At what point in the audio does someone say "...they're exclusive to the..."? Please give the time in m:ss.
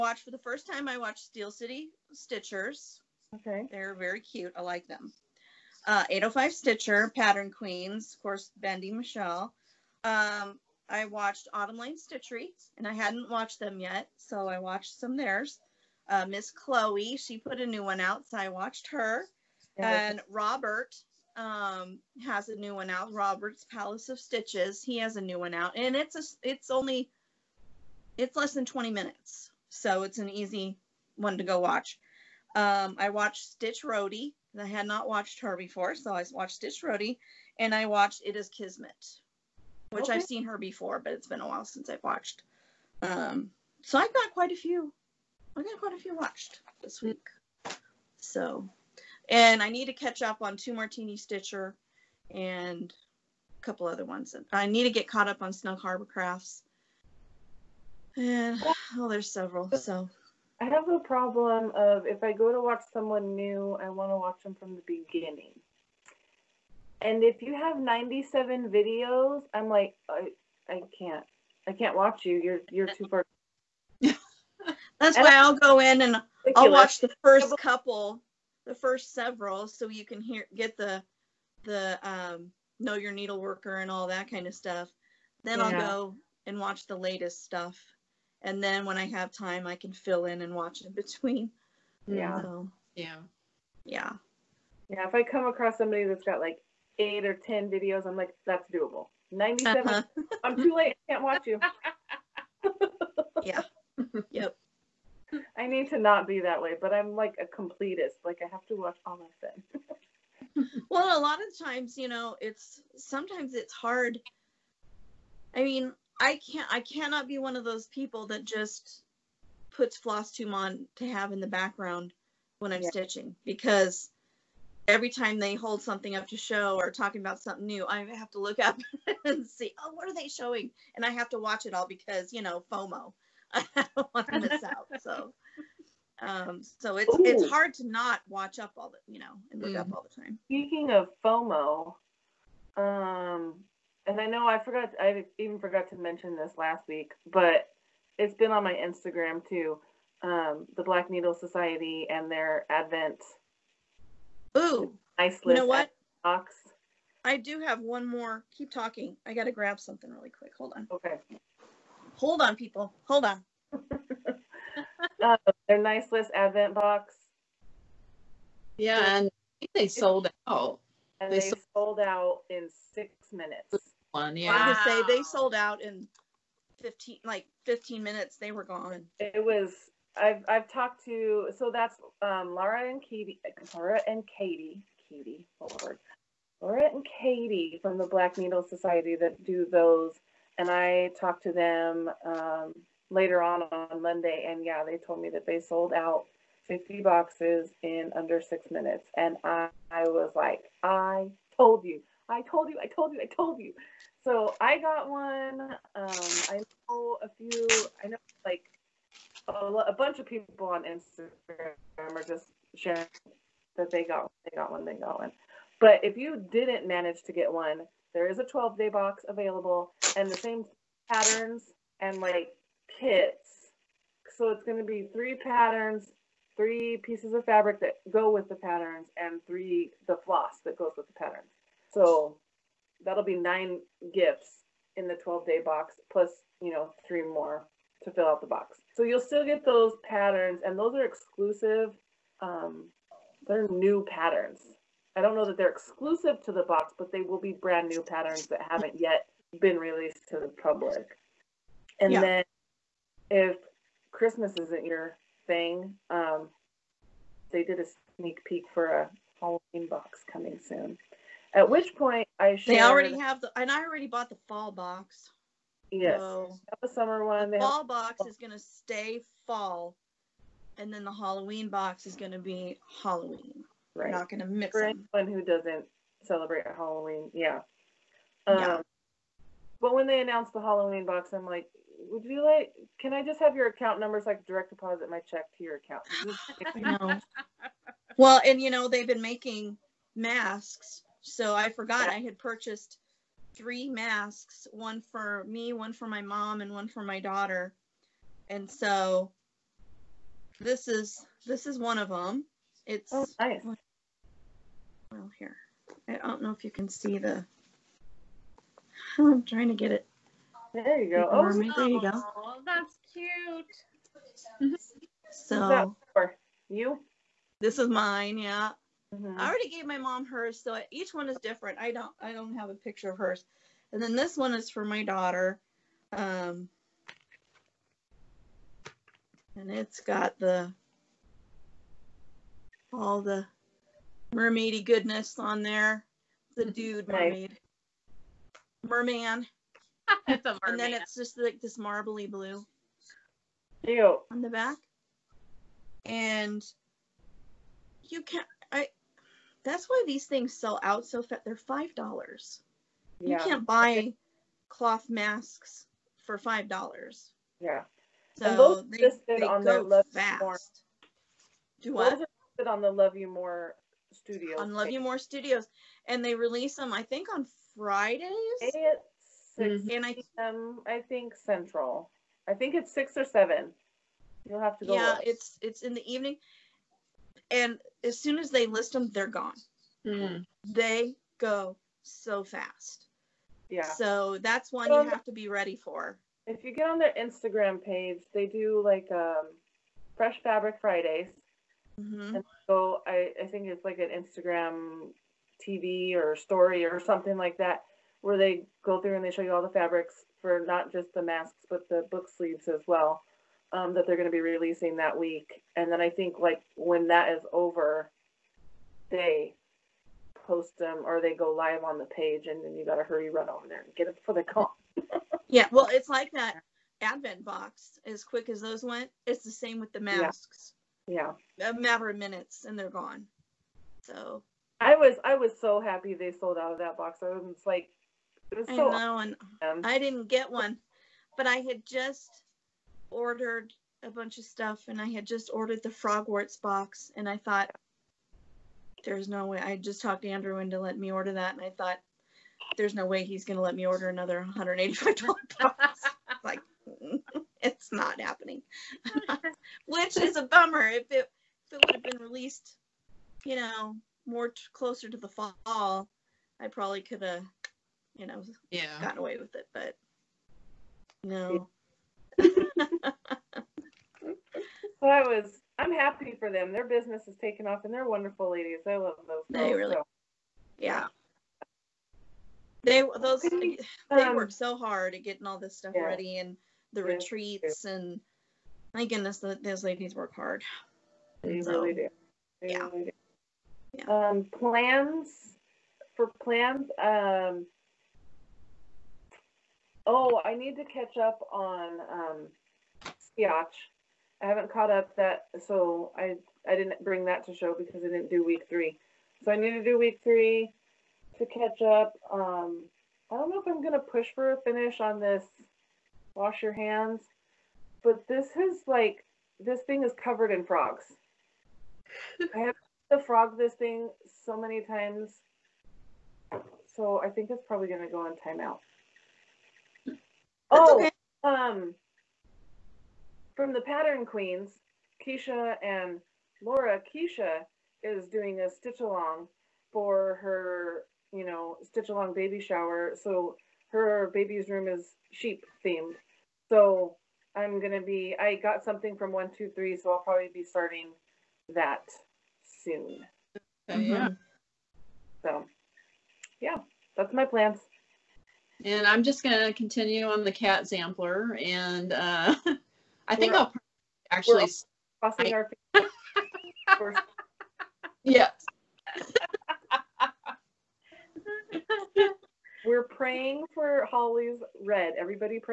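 4:05.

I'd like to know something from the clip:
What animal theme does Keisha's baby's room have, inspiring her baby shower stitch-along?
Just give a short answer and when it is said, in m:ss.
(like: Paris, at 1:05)
Sheep, at 8:55.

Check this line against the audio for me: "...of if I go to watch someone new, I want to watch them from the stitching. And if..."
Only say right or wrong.
wrong.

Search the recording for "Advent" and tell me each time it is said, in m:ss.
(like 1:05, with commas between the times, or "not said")
2:32, 2:46, 6:57.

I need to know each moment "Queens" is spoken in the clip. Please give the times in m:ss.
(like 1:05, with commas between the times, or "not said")
0:07, 8:44.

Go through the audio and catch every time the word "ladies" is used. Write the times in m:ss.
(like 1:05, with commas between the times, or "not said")
7:48, 7:59.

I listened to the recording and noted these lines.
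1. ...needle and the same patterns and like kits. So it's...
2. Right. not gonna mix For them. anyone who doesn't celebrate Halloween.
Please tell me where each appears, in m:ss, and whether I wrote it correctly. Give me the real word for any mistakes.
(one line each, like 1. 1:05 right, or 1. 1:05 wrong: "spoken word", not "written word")
1. 3:39 wrong: "available", not "needle"
2. 4:33 right.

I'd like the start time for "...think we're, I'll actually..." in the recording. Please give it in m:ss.
9:13.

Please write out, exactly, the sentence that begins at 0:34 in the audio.
I had not watched her before, so I watched Stitch Roadie, and I watched It Is Kismet, which okay.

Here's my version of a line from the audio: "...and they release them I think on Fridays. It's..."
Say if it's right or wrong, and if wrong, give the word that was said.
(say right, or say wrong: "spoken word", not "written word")
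right.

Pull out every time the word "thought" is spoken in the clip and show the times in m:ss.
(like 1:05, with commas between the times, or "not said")
7:17, 7:21.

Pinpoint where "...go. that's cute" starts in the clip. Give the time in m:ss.
5:12.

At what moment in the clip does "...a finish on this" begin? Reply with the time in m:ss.
8:24.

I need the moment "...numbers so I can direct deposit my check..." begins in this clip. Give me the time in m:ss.
4:43.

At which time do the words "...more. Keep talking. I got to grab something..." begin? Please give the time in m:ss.
2:38.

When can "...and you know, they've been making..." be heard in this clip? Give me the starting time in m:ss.
4:48.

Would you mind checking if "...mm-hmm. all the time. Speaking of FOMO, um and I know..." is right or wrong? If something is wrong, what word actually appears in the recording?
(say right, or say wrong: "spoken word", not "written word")
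right.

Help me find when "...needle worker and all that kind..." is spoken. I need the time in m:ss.
1:23.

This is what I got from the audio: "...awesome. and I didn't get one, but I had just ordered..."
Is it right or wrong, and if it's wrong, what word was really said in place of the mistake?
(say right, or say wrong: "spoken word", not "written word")
right.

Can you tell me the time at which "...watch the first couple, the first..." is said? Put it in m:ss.
1:16.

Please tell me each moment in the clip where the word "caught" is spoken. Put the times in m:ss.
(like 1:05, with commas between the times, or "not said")
0:55, 8:14.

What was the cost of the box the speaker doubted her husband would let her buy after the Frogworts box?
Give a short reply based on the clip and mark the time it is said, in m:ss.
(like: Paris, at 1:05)
$185, at 7:24.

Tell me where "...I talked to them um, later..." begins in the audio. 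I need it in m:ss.
3:10.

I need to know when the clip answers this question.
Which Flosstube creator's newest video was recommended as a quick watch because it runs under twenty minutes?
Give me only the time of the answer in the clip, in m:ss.
0:23.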